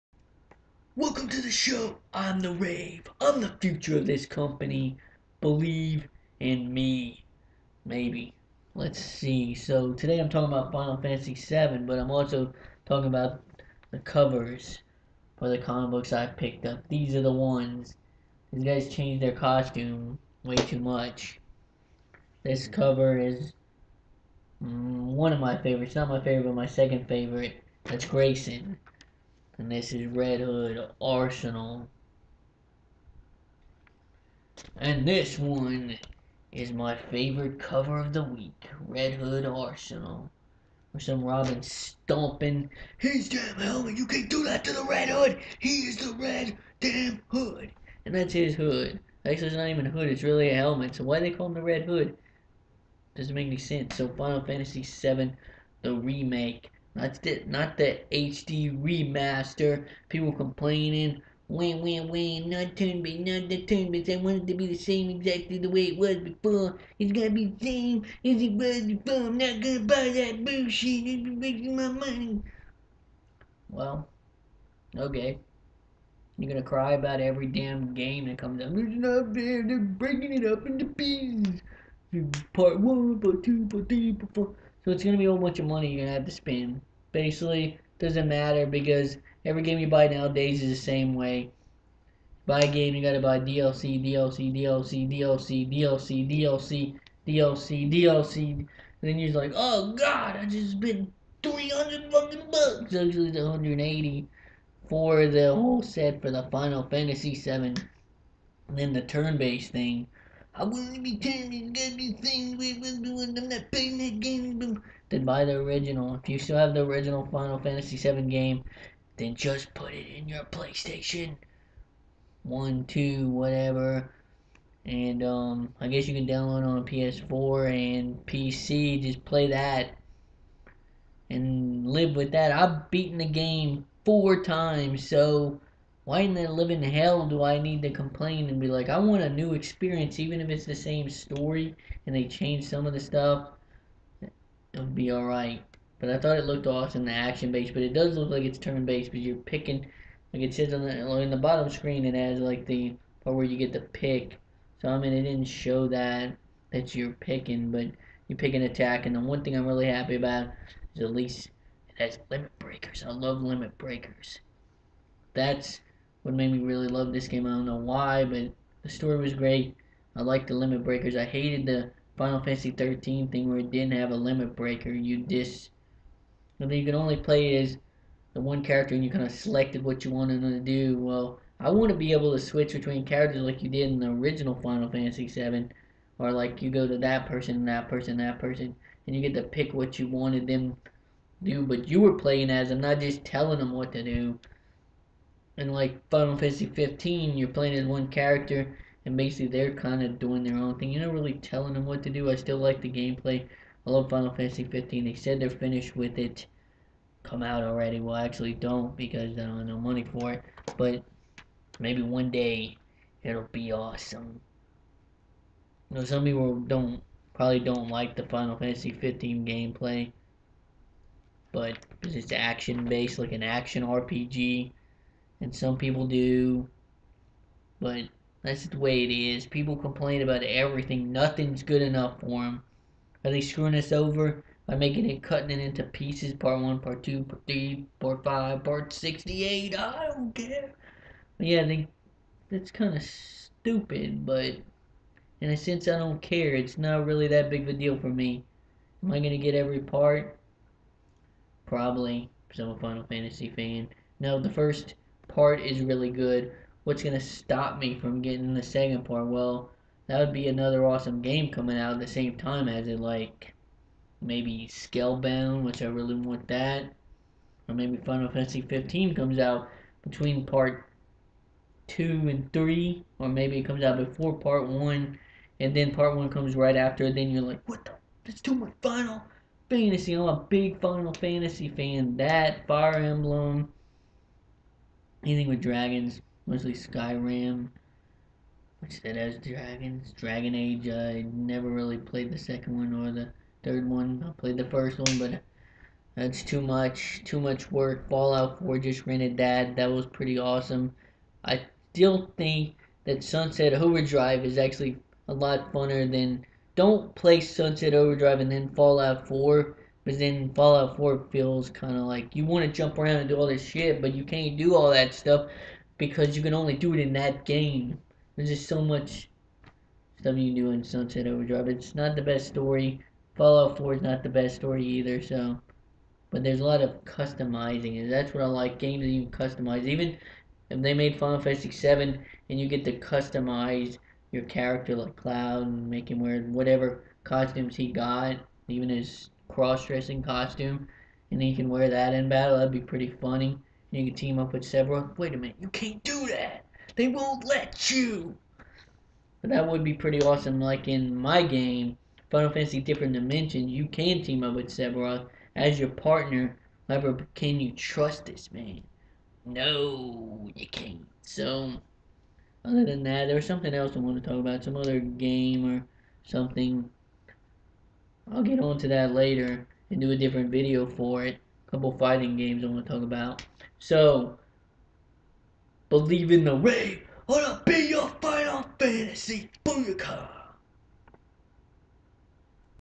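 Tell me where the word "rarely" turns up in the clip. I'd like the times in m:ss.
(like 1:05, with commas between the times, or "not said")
not said.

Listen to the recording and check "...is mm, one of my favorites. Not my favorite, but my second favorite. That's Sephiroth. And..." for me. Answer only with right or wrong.
wrong.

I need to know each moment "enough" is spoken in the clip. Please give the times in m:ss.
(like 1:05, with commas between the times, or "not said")
3:51.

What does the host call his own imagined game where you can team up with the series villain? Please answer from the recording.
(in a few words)
Final Fantasy Different Dimensions.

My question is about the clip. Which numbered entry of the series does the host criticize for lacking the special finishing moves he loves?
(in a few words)
Final Fantasy 13.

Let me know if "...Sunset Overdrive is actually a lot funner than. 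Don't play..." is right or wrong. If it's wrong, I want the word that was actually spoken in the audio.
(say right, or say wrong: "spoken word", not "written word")
right.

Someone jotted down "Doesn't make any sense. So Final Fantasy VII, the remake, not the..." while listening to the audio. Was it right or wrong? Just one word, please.
right.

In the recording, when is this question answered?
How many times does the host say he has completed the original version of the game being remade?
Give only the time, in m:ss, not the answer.
2:14.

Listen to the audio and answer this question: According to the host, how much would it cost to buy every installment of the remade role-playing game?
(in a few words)
$180.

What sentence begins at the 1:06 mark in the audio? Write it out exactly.
It's gonna be the same as it was before.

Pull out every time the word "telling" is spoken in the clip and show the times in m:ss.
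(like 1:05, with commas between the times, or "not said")
3:13, 3:21.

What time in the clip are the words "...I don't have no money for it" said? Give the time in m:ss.
3:29.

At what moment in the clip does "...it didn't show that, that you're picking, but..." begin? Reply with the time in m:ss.
2:35.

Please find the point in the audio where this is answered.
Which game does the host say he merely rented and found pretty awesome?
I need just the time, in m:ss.
4:58.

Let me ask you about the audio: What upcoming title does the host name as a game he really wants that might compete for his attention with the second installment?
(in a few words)
Scalebound.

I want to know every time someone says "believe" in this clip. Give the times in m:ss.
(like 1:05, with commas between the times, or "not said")
0:05, 6:15.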